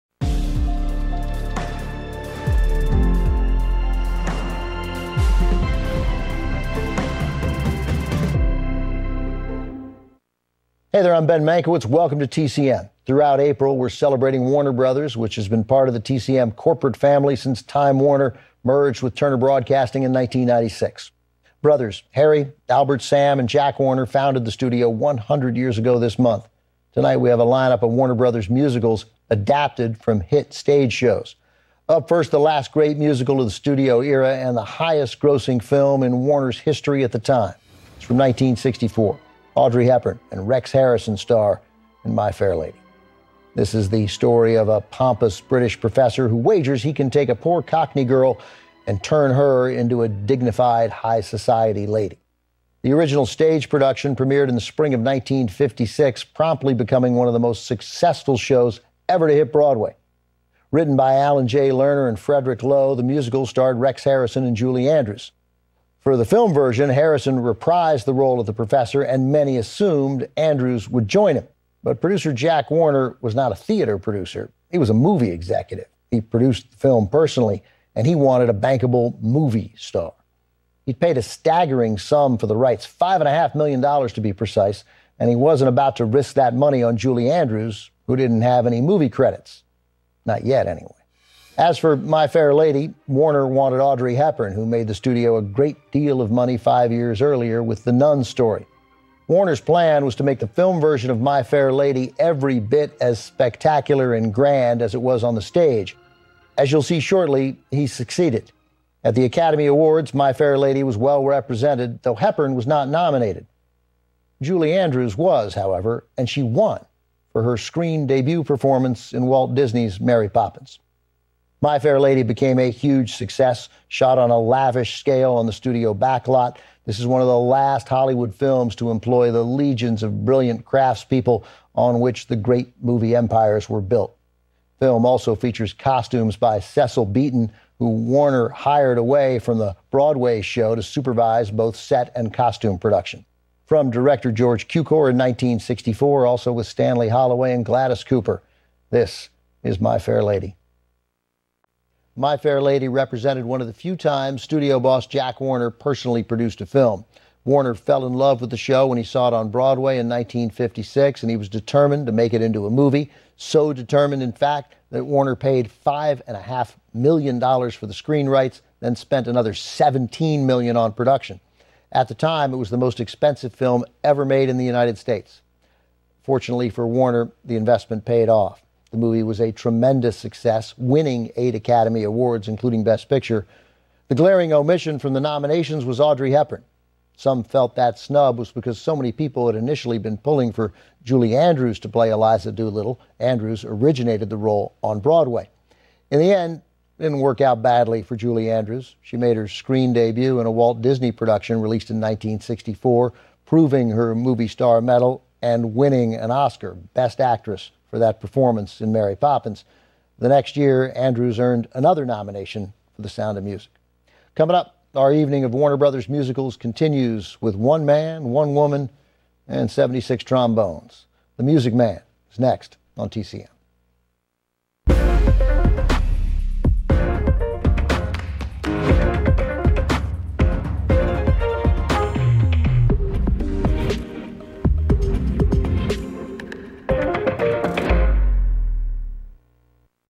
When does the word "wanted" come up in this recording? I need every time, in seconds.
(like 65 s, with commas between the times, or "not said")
78 s, 93 s.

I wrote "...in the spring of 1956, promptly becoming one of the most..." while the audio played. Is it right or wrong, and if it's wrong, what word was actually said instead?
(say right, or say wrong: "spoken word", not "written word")
right.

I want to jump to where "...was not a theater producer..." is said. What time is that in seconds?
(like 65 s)
73 s.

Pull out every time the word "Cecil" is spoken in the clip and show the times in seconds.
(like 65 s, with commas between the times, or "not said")
136 s.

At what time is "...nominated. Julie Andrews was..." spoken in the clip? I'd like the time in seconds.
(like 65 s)
112 s.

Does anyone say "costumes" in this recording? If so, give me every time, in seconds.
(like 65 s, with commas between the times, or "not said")
135 s, 142 s.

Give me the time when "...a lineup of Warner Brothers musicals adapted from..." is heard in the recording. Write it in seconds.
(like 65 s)
27 s.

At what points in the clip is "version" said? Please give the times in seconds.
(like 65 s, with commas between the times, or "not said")
66 s, 100 s.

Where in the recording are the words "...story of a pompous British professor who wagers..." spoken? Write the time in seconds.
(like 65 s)
44 s.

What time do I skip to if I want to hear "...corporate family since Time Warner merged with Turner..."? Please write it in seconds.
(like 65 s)
16 s.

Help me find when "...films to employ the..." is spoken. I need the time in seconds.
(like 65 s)
128 s.